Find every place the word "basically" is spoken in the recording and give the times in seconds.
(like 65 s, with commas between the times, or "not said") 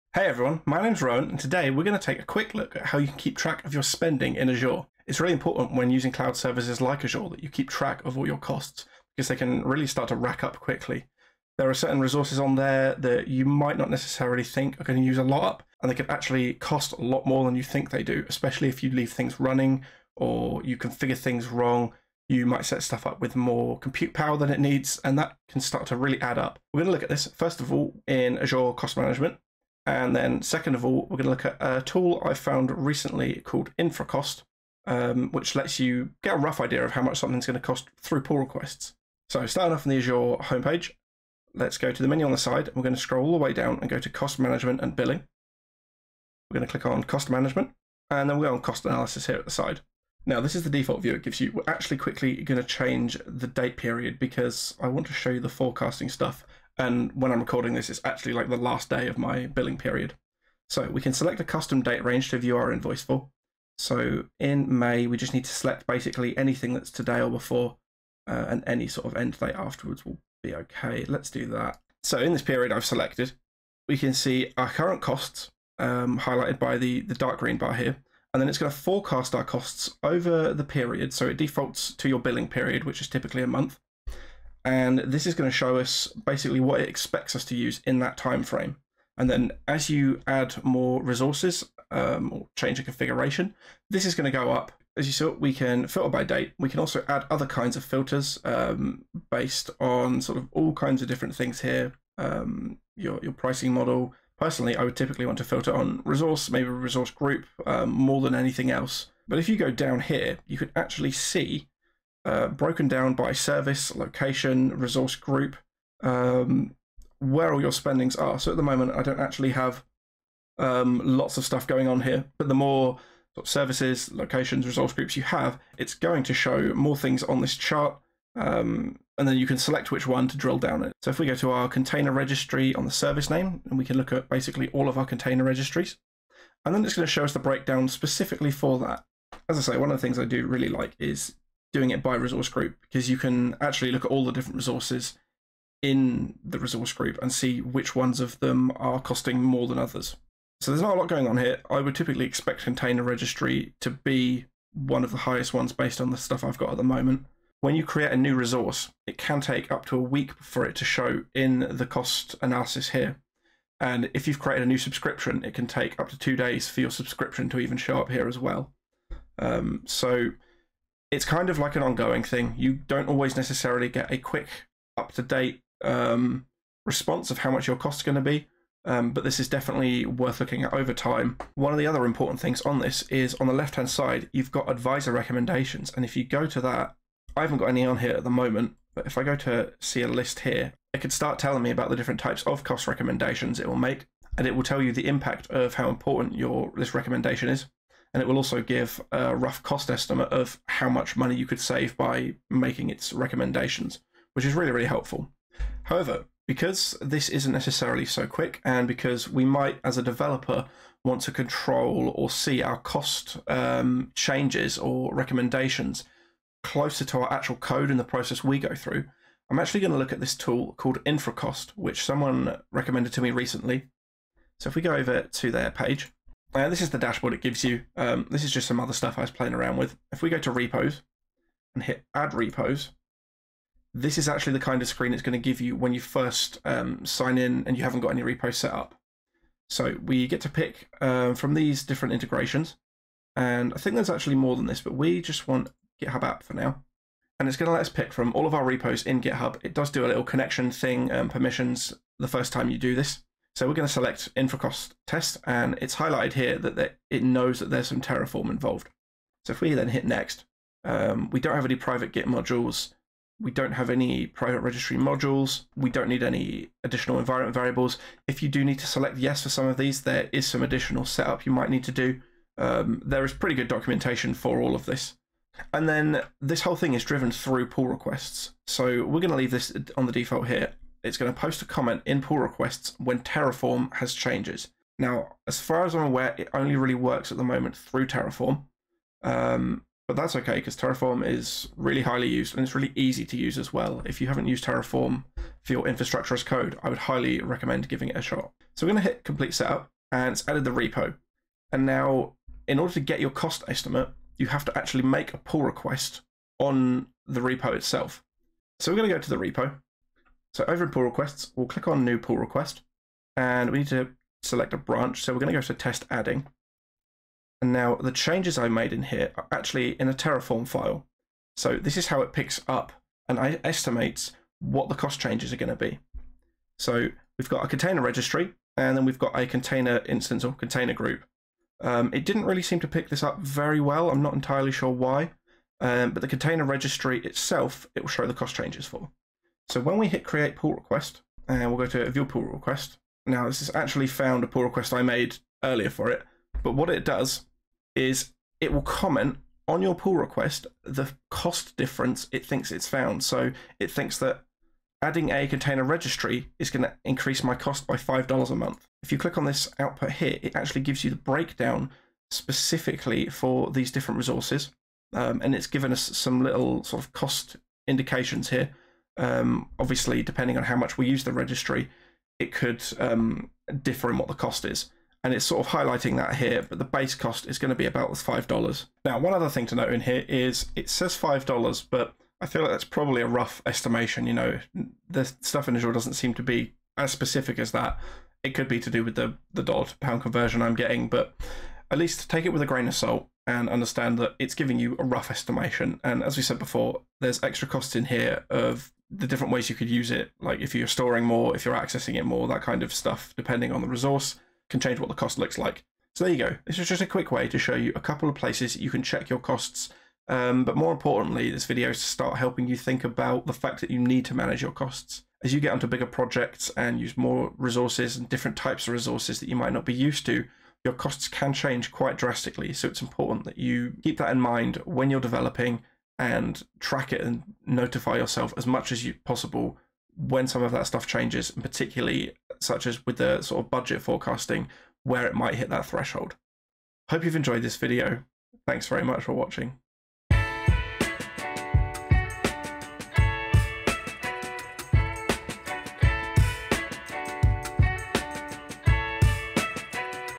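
65 s, 86 s, 134 s.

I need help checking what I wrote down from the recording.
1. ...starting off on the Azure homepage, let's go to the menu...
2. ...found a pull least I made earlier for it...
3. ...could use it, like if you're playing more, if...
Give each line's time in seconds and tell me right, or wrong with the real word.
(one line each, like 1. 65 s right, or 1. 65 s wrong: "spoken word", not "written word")
1. 39 s right
2. 344 s wrong: "request", not "least"
3. 399 s wrong: "storing", not "playing".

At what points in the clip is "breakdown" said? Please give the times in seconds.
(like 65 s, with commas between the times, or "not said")
137 s, 361 s.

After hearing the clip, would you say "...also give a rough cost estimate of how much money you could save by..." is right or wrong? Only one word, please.
right.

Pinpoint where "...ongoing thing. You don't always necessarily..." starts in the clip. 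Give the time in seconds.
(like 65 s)
171 s.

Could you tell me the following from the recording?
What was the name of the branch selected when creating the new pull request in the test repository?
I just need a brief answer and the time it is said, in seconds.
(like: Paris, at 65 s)
test adding, at 315 s.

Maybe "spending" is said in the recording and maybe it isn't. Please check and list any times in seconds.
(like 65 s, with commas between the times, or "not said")
3 s, 117 s.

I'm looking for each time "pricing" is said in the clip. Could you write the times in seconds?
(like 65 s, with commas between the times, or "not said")
103 s.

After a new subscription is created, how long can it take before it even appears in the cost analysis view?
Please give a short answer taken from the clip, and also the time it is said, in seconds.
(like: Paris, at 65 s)
2 days, at 166 s.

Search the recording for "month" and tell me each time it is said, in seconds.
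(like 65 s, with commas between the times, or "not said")
83 s, 358 s.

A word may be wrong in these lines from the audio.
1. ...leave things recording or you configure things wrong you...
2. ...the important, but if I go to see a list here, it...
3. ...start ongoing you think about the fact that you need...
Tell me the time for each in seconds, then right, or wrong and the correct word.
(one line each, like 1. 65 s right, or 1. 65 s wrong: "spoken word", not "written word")
1. 18 s wrong: "running", not "recording"
2. 188 s wrong: "moment", not "important"
3. 412 s wrong: "helping", not "ongoing".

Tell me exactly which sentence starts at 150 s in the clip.
So there's not a lot going on here.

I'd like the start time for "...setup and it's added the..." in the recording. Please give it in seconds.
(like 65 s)
299 s.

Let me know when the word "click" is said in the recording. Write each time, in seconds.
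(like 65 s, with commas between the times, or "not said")
46 s, 311 s, 359 s.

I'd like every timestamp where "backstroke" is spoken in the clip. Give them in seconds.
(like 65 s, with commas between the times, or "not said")
not said.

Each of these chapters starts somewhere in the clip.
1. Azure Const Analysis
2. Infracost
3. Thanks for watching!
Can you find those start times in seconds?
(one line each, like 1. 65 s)
1. 39 s
2. 205 s
3. 405 s.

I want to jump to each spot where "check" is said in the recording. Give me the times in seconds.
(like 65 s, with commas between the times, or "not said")
409 s.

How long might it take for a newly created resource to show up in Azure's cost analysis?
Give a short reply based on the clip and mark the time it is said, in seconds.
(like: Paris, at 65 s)
a week, at 159 s.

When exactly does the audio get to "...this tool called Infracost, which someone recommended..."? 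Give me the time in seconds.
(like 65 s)
220 s.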